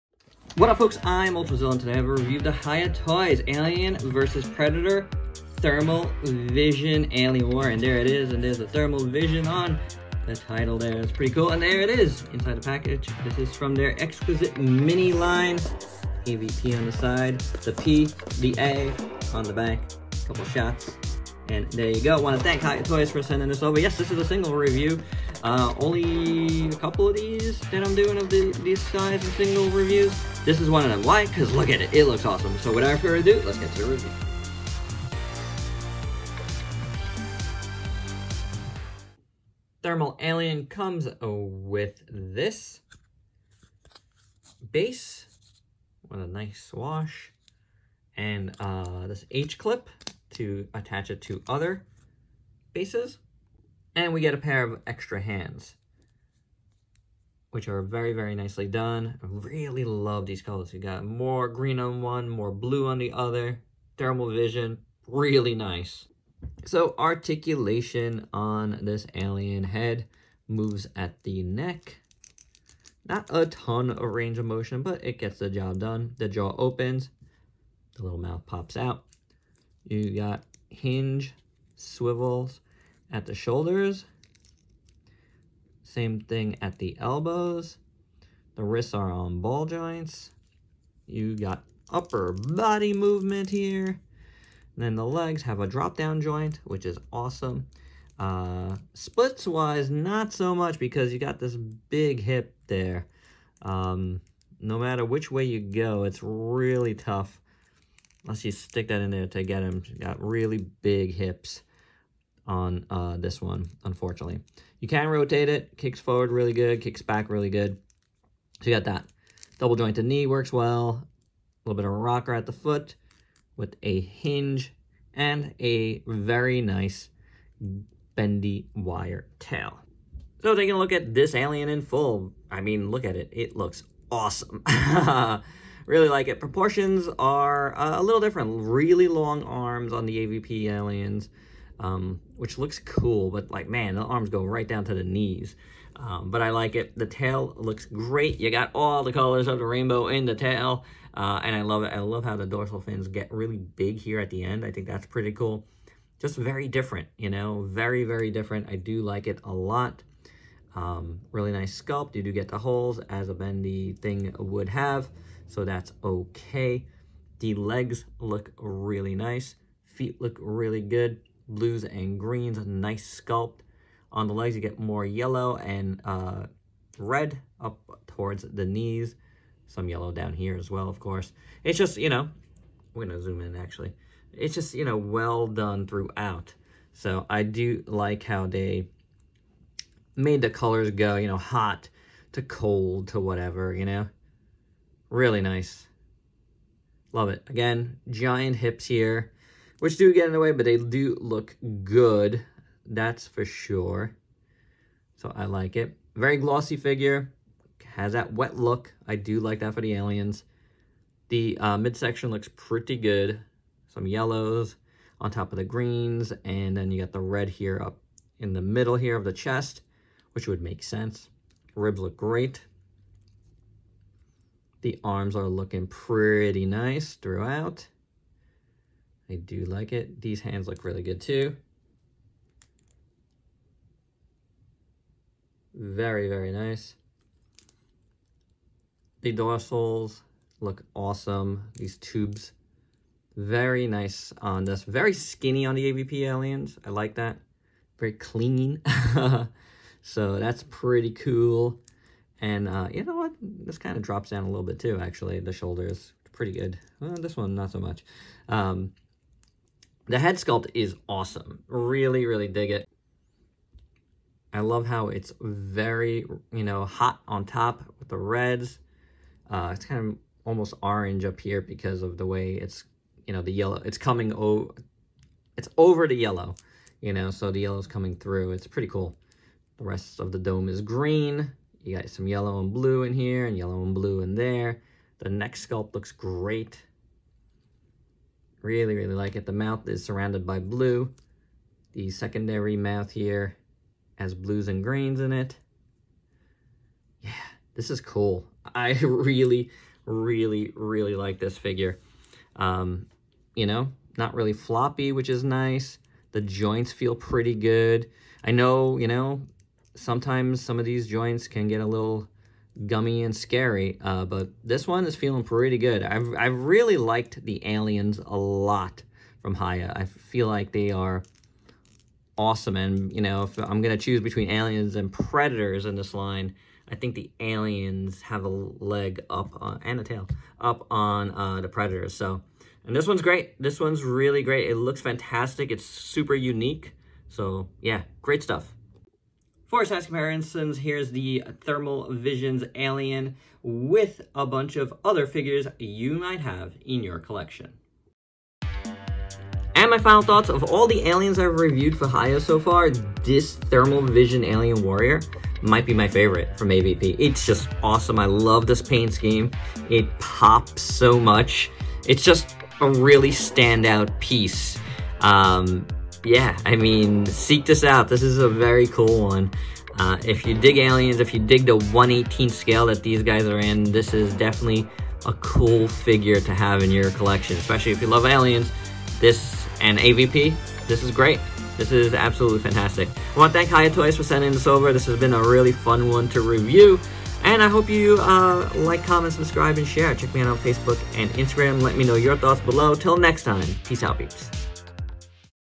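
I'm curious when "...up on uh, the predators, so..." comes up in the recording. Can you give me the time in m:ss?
5:30.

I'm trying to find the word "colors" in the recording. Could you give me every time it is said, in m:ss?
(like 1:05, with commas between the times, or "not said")
1:00, 2:29, 3:10.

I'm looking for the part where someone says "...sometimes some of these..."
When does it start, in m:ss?
5:09.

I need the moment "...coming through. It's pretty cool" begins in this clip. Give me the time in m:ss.
4:37.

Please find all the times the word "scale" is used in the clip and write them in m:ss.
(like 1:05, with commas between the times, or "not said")
6:12.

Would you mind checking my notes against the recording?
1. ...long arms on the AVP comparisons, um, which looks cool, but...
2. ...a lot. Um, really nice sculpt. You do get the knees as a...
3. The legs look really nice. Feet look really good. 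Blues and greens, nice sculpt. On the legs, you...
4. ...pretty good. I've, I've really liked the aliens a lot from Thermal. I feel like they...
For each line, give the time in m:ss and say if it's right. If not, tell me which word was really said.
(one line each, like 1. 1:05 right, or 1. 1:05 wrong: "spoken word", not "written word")
1. 2:19 wrong: "aliens", not "comparisons"
2. 2:39 wrong: "holes", not "knees"
3. 2:47 right
4. 5:15 wrong: "Hiya", not "Thermal".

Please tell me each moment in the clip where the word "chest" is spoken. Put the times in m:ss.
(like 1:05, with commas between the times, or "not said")
3:39.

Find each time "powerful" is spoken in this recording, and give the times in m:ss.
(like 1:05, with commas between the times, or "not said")
not said.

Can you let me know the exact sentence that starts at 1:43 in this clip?
Um, no matter which way you go, it's really tough Unless you stick that in there to get him.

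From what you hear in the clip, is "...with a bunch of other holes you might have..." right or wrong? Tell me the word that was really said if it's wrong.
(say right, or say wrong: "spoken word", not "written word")
wrong: "figures", not "holes".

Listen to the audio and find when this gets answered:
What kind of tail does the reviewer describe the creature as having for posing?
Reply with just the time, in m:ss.
2:08.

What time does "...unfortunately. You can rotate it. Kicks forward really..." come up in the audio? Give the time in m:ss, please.
1:53.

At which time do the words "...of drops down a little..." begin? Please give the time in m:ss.
4:13.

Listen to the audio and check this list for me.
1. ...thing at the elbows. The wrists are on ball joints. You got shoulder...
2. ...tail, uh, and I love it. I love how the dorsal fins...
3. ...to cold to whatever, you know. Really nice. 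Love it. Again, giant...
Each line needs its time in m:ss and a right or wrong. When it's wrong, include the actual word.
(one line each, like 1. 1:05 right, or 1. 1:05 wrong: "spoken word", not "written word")
1. 1:26 wrong: "upper", not "shoulder"
2. 2:30 right
3. 3:12 right.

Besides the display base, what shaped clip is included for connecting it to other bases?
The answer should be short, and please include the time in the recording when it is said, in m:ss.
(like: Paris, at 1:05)
H-clip, at 0:49.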